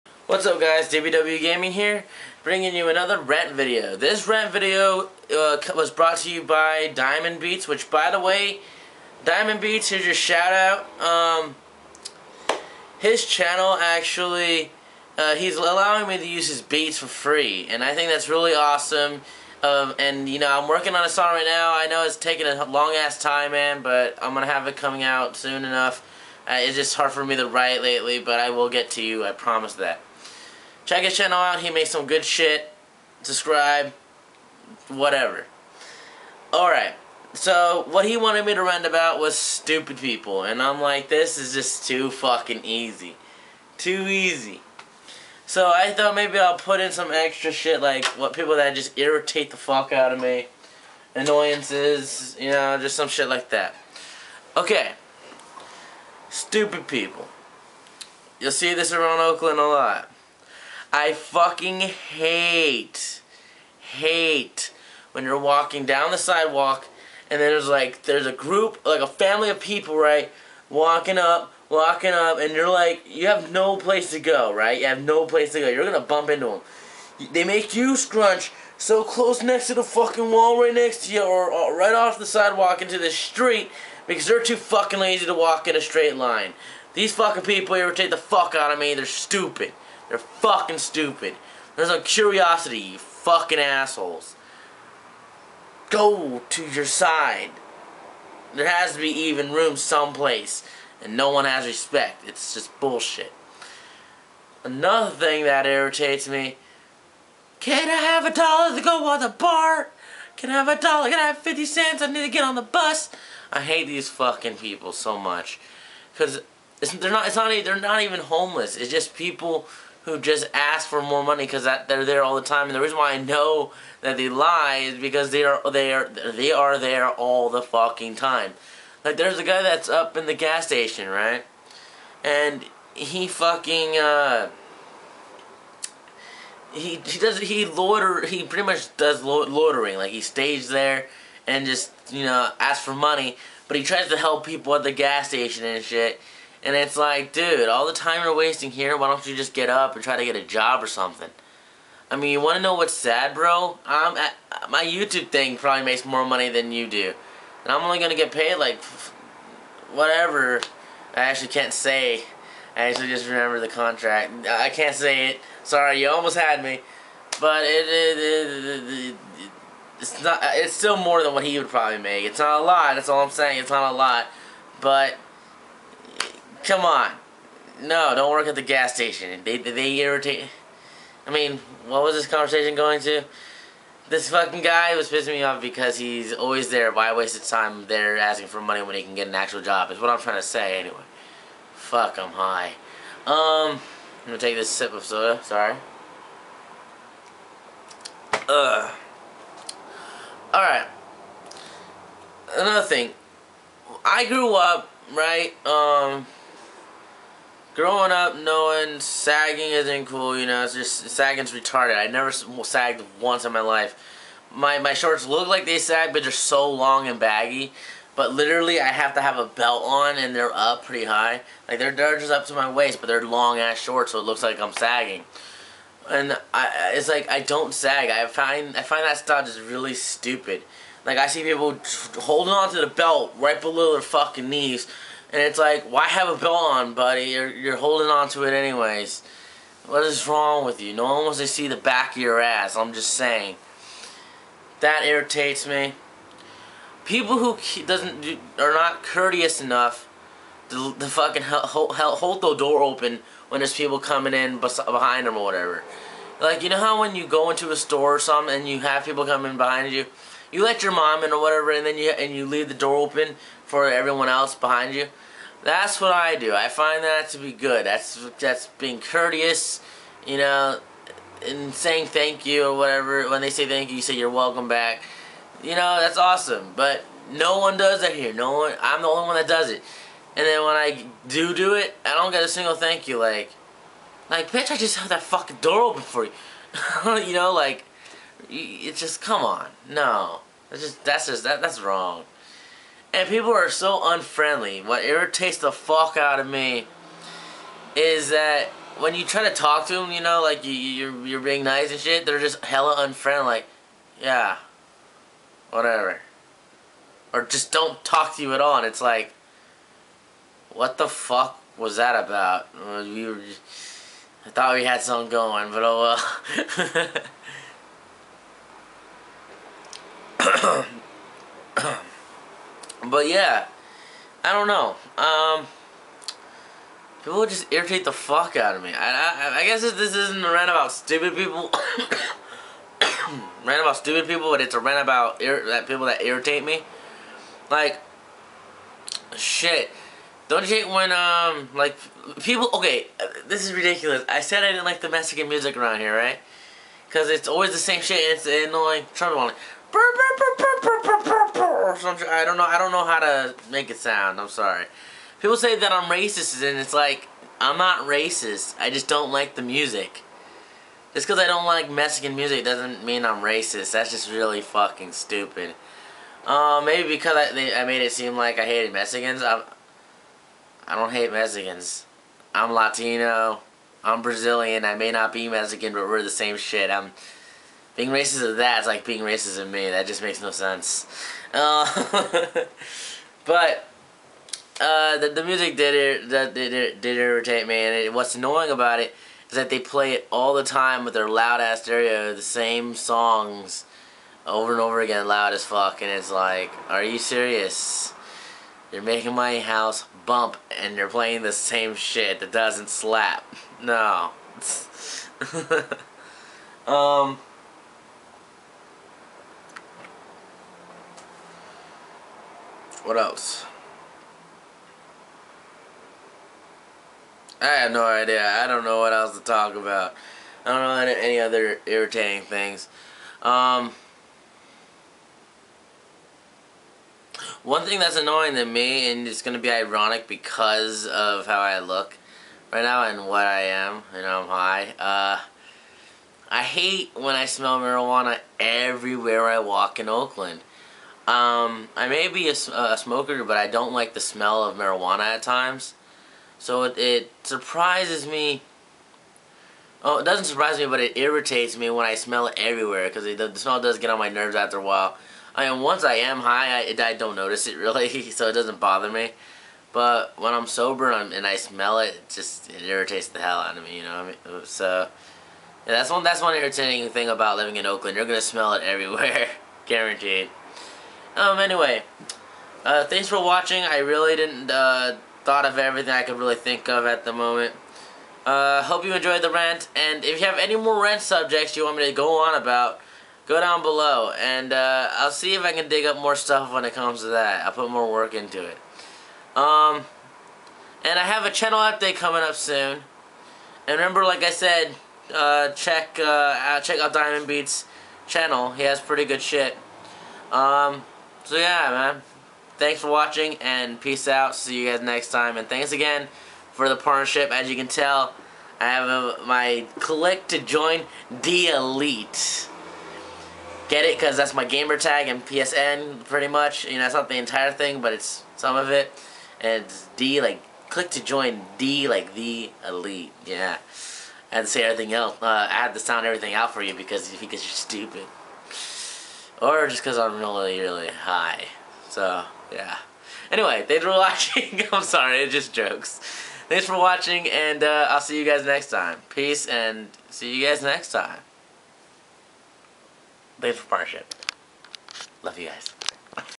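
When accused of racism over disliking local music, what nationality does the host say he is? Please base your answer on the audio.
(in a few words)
Brazilian.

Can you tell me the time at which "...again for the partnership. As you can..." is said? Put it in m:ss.
8:25.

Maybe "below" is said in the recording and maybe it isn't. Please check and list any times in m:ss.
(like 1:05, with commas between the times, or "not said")
3:53, 8:03.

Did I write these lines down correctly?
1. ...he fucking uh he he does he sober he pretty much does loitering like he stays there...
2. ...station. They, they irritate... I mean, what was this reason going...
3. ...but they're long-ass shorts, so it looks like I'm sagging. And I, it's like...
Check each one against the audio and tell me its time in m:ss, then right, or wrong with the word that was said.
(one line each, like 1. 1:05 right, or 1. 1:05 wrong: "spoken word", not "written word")
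1. 2:12 wrong: "loiter", not "sober"
2. 2:58 wrong: "conversation", not "reason"
3. 3:42 right.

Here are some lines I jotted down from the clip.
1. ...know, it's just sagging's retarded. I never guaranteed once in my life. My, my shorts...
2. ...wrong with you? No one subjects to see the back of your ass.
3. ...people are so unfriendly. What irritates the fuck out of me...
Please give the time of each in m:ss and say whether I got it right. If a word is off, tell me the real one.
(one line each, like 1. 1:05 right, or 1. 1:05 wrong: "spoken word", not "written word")
1. 3:30 wrong: "sagged", not "guaranteed"
2. 4:00 wrong: "wants", not "subjects"
3. 4:53 right.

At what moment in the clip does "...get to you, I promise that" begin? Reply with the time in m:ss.
0:28.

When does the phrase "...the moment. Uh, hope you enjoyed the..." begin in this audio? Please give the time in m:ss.
7:57.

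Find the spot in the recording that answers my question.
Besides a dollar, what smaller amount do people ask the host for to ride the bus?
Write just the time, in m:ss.
1:51.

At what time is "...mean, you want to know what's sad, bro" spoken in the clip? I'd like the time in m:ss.
2:32.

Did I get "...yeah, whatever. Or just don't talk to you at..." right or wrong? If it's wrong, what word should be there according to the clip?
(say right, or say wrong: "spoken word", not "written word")
right.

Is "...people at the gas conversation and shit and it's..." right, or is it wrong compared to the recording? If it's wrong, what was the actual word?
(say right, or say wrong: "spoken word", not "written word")
wrong: "station", not "conversation".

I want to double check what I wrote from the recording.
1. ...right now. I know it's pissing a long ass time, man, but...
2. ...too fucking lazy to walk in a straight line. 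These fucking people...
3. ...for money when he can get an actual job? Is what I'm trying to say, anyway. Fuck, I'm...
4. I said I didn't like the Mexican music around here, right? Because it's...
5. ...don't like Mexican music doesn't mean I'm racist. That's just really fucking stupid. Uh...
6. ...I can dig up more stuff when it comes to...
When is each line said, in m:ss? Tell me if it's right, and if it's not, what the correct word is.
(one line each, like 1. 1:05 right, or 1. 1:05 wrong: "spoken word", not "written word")
1. 0:21 wrong: "taking", not "pissing"
2. 1:24 right
3. 3:08 right
4. 5:44 right
5. 6:01 right
6. 8:05 right.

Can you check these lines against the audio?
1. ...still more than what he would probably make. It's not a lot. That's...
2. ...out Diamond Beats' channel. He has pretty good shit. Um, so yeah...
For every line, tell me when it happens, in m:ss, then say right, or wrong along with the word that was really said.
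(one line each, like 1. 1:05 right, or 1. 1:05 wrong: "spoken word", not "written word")
1. 2:50 right
2. 8:16 right.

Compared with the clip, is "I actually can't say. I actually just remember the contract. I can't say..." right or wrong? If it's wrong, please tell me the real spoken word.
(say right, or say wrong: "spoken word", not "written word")
right.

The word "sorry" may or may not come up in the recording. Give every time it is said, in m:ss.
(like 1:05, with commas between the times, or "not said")
2:45, 3:15, 5:54, 8:55.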